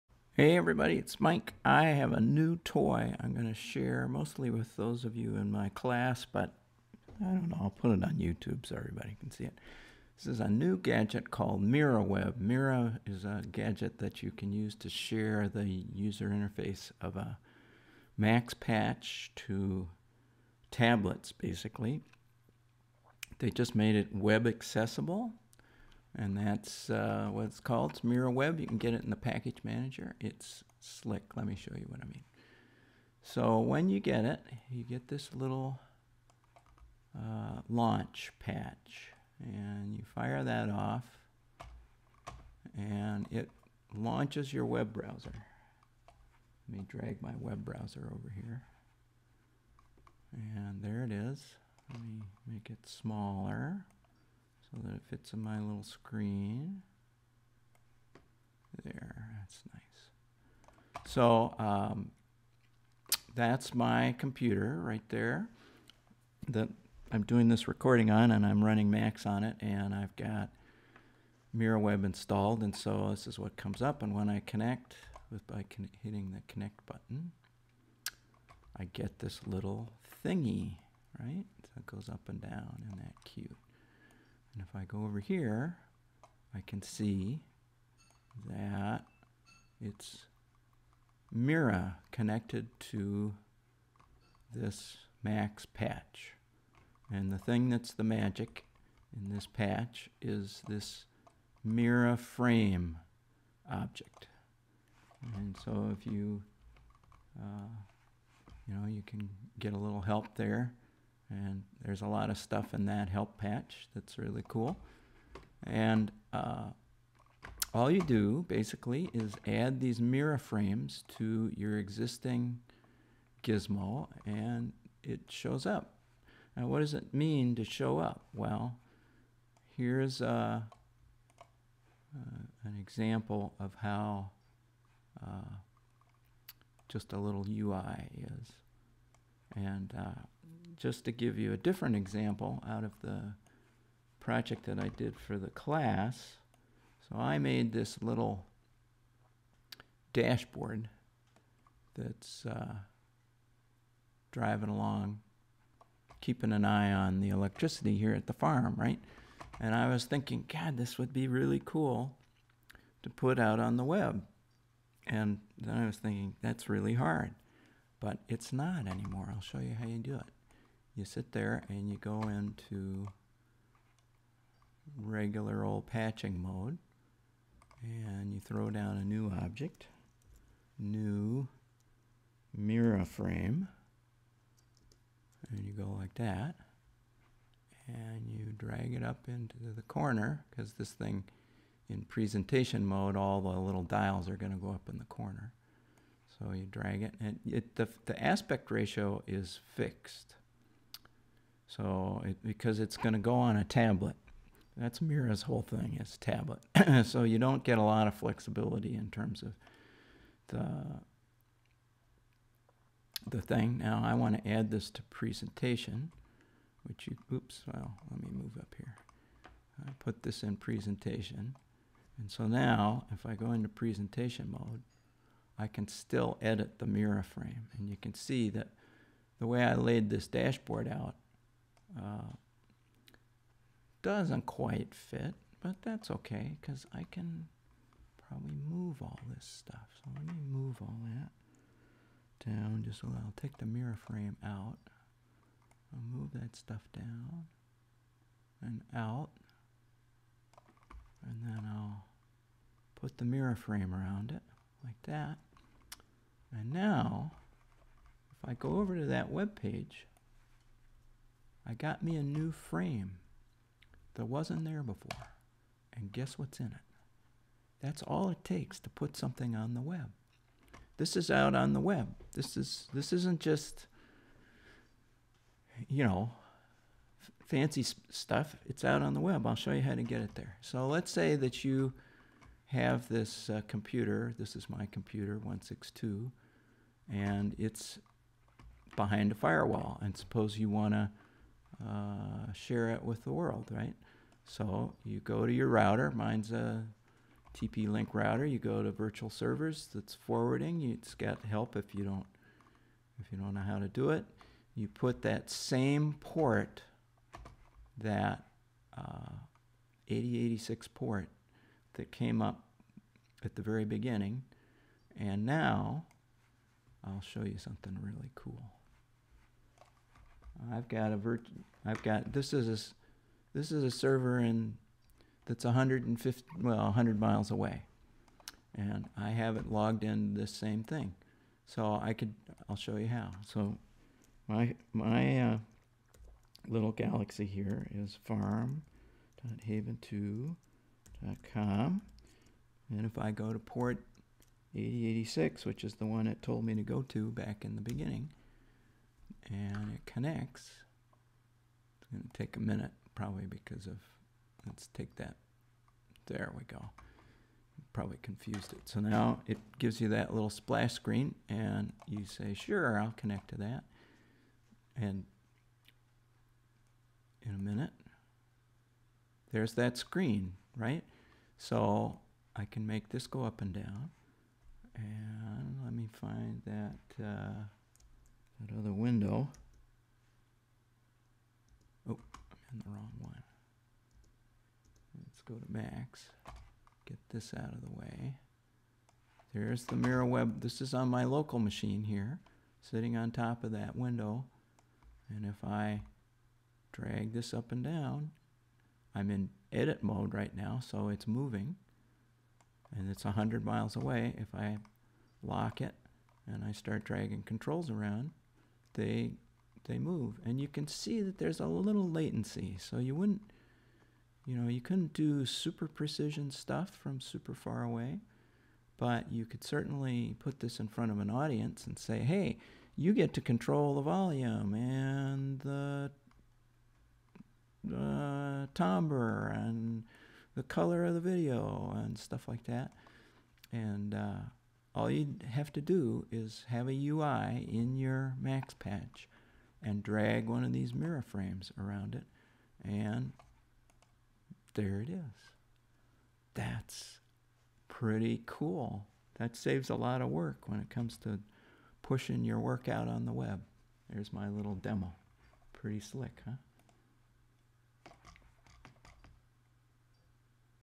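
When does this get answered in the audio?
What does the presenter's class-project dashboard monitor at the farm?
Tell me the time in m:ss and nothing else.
2:37.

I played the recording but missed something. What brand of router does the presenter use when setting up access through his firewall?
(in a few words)
TP-Link.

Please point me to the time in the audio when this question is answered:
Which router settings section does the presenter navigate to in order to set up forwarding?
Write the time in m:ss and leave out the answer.
4:58.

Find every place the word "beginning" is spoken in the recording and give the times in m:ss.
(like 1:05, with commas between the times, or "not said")
5:13, 5:47.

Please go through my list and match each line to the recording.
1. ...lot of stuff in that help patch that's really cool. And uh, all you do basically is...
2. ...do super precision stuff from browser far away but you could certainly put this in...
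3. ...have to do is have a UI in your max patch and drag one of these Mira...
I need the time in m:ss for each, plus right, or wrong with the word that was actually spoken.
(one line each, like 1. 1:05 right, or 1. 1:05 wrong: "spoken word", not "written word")
1. 1:52 right
2. 6:55 wrong: "super", not "browser"
3. 7:15 right.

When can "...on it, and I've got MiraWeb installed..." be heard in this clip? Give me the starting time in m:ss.
1:09.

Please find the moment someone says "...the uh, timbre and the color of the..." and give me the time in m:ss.
7:05.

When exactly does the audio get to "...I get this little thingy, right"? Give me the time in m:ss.
1:18.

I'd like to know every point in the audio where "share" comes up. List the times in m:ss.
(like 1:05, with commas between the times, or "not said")
0:03, 0:14, 4:52.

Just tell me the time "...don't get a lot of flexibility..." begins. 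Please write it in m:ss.
3:27.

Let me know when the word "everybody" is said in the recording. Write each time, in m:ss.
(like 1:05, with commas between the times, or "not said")
0:00, 0:08.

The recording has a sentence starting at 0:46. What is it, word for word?
Let me drag my web browser over here.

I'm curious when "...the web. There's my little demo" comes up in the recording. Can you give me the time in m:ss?
7:33.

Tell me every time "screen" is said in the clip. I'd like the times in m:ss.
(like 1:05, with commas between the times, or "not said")
0:55, 6:00, 6:09.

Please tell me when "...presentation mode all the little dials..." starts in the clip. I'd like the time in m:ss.
3:12.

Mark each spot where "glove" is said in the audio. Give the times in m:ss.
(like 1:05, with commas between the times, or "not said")
not said.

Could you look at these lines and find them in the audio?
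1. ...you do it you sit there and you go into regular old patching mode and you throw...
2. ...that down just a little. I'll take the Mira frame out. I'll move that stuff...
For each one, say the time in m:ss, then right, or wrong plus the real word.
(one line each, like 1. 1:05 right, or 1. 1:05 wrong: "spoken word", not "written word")
1. 2:49 right
2. 4:01 right.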